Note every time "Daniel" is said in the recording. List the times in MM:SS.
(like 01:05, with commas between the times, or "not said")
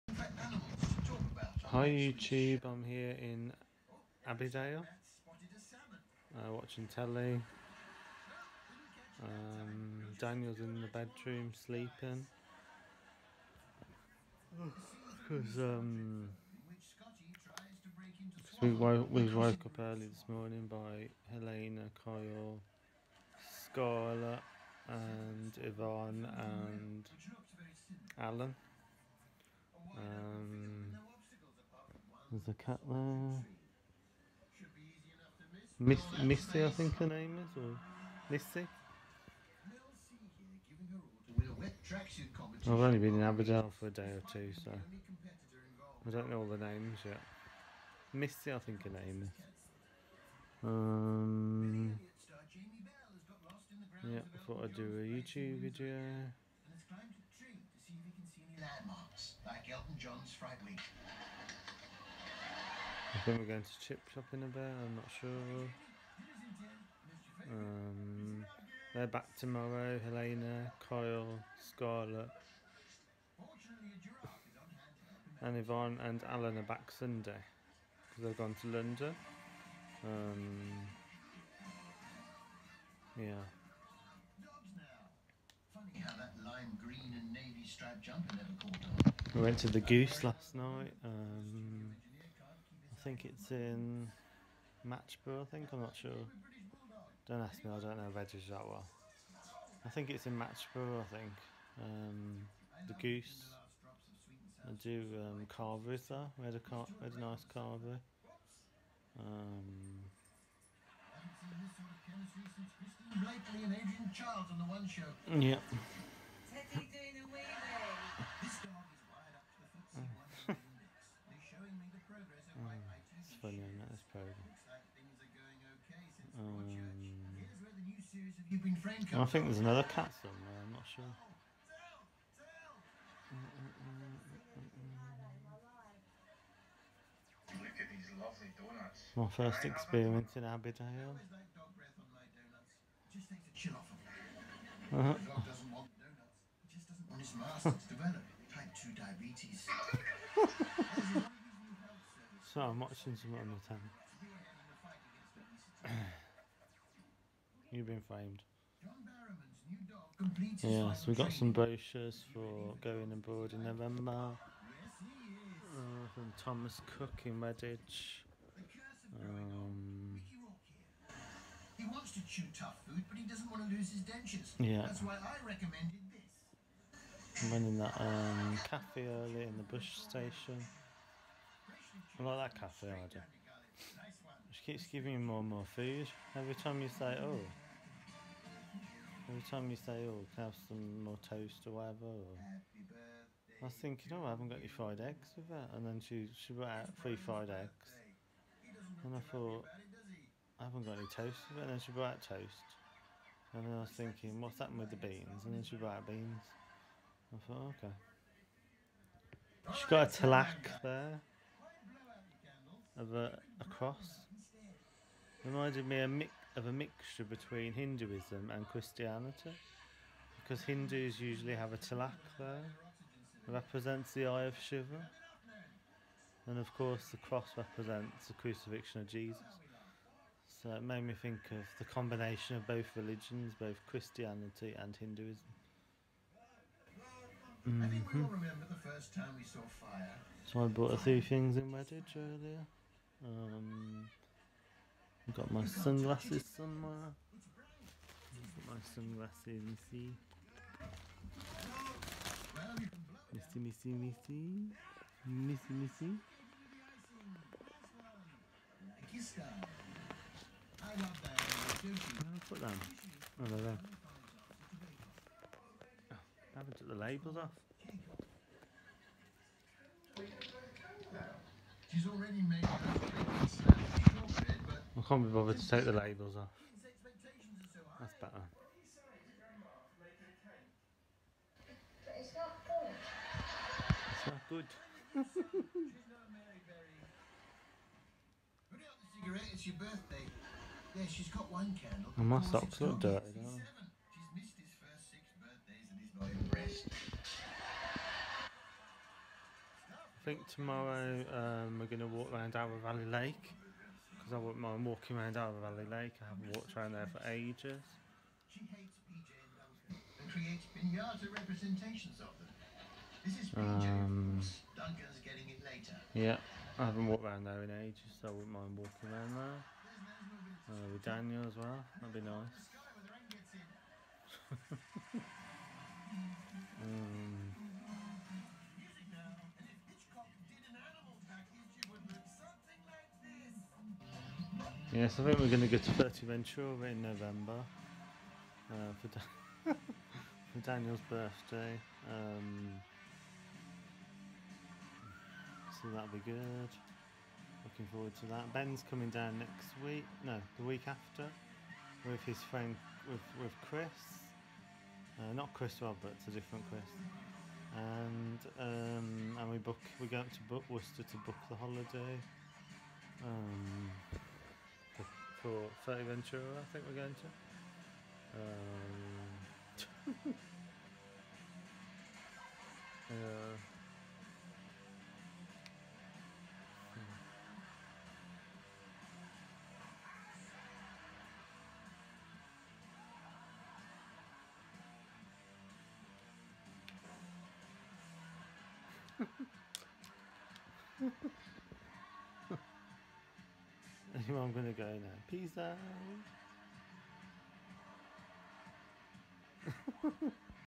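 00:10, 05:21, 05:40.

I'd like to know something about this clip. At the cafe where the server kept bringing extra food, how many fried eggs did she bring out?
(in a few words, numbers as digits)
3.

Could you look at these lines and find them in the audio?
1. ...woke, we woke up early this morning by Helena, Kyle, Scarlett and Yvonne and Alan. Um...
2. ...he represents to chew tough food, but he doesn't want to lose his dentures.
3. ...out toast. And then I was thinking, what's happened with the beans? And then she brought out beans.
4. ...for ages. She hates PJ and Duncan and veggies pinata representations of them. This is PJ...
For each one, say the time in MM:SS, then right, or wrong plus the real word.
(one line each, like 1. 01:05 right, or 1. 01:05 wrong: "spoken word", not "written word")
1. 00:18 right
2. 02:51 wrong: "wants", not "represents"
3. 03:22 right
4. 05:07 wrong: "creates", not "veggies".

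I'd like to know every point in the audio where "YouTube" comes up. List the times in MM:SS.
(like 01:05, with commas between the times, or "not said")
00:01, 00:54.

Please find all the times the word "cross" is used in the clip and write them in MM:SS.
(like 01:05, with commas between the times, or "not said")
03:33, 03:47.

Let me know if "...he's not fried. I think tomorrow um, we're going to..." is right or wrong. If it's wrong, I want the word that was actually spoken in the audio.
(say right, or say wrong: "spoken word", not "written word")
wrong: "impressed", not "fried".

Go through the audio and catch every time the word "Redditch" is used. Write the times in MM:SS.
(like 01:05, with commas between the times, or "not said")
02:47, 04:01.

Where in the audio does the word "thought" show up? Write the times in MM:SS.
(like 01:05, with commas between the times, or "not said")
00:54, 03:19, 03:27.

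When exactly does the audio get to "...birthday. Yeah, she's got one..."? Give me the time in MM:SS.
04:49.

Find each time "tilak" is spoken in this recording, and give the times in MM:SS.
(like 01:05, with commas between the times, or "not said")
03:30, 03:41.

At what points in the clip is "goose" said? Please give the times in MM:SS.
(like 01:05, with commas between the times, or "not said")
01:29, 01:43.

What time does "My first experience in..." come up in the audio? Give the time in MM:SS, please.
02:19.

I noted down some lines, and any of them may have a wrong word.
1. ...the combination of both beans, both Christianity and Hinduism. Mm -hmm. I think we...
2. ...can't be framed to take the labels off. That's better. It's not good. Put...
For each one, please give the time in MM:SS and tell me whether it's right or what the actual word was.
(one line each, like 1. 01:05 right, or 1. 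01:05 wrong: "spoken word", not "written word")
1. 03:51 wrong: "religions", not "beans"
2. 04:35 wrong: "bothered", not "framed".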